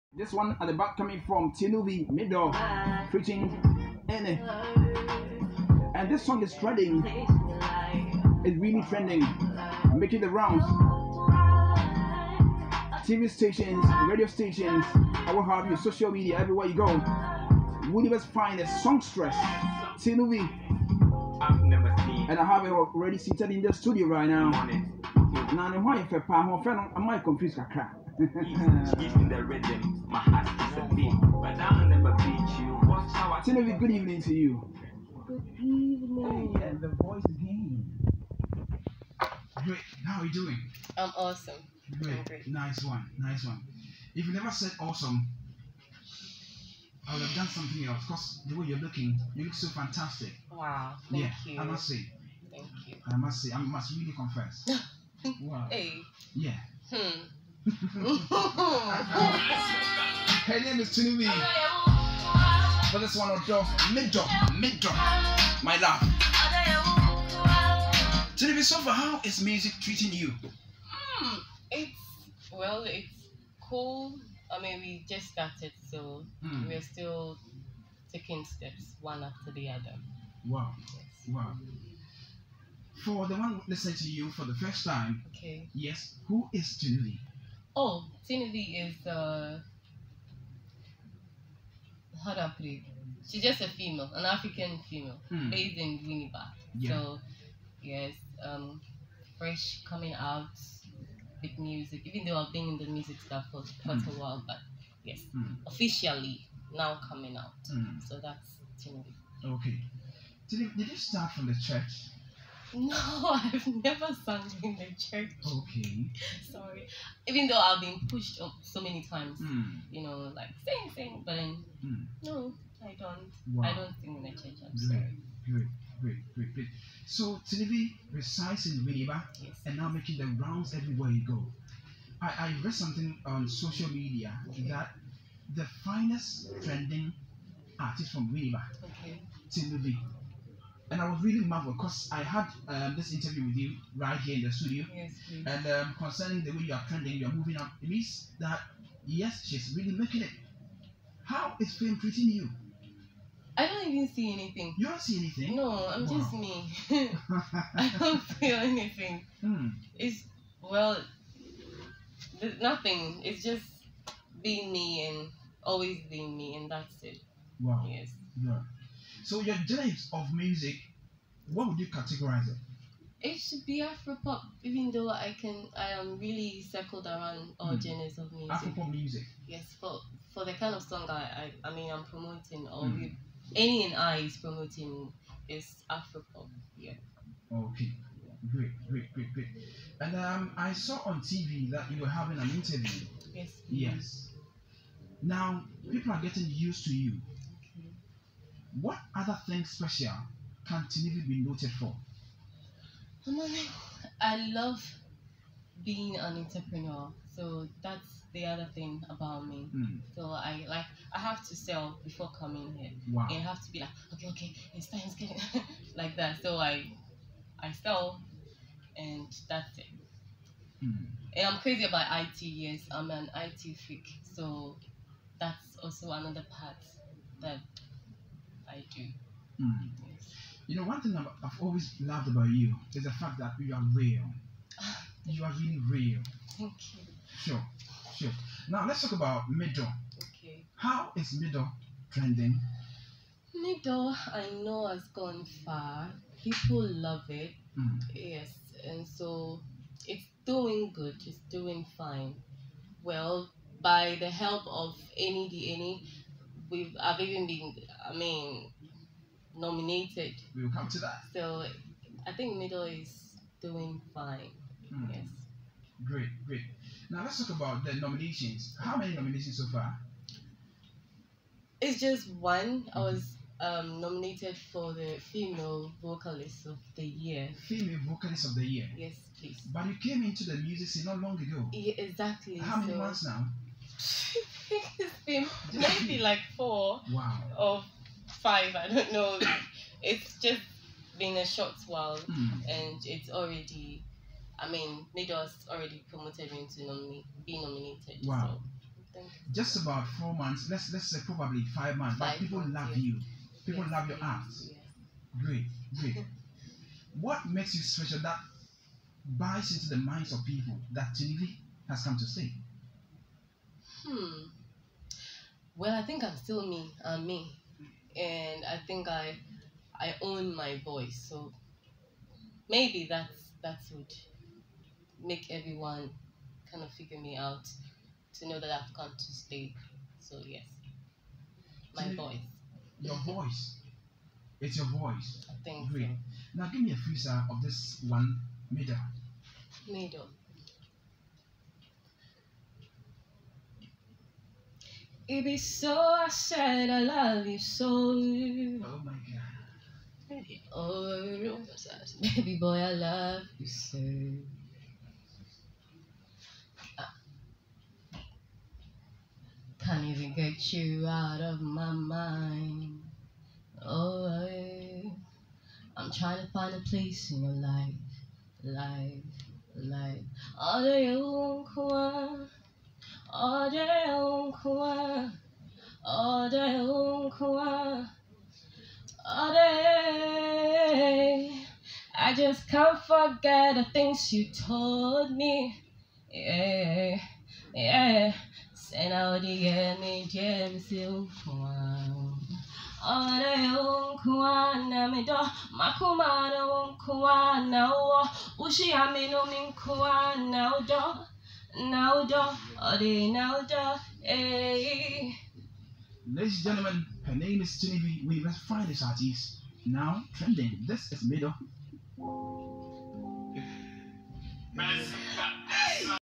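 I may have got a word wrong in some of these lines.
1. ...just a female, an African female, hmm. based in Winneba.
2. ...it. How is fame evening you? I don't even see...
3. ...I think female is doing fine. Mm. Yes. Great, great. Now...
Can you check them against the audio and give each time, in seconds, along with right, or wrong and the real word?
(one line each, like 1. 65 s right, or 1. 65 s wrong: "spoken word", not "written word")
1. 93 s right
2. 150 s wrong: "treating", not "evening"
3. 262 s wrong: "middle", not "female".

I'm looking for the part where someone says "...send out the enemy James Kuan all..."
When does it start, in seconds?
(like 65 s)
388 s.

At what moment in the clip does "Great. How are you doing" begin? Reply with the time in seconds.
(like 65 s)
39 s.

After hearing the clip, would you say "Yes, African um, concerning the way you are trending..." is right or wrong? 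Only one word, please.
wrong.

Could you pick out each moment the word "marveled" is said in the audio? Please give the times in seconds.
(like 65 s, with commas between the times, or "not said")
141 s.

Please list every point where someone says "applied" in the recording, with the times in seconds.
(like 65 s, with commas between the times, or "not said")
not said.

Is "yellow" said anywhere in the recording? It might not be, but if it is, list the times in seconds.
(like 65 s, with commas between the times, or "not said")
not said.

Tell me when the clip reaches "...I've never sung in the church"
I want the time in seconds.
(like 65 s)
113 s.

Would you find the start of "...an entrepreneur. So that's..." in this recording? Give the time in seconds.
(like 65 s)
206 s.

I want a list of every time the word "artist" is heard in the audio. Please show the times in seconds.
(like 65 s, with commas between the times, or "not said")
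137 s, 409 s.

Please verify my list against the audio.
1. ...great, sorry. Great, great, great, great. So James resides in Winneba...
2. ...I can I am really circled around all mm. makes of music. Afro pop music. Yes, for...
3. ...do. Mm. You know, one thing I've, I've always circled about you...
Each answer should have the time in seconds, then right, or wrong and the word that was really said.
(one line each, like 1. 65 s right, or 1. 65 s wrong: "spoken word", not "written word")
1. 124 s wrong: "Tinuvi", not "James"
2. 175 s wrong: "genres", not "makes"
3. 228 s wrong: "loved", not "circled".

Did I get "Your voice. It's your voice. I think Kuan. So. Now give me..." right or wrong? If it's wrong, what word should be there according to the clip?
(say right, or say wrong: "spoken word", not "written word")
wrong: "Great", not "Kuan".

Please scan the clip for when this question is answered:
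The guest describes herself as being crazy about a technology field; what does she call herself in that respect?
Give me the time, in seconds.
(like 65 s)
223 s.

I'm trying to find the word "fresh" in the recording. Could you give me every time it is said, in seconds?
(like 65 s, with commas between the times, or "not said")
99 s.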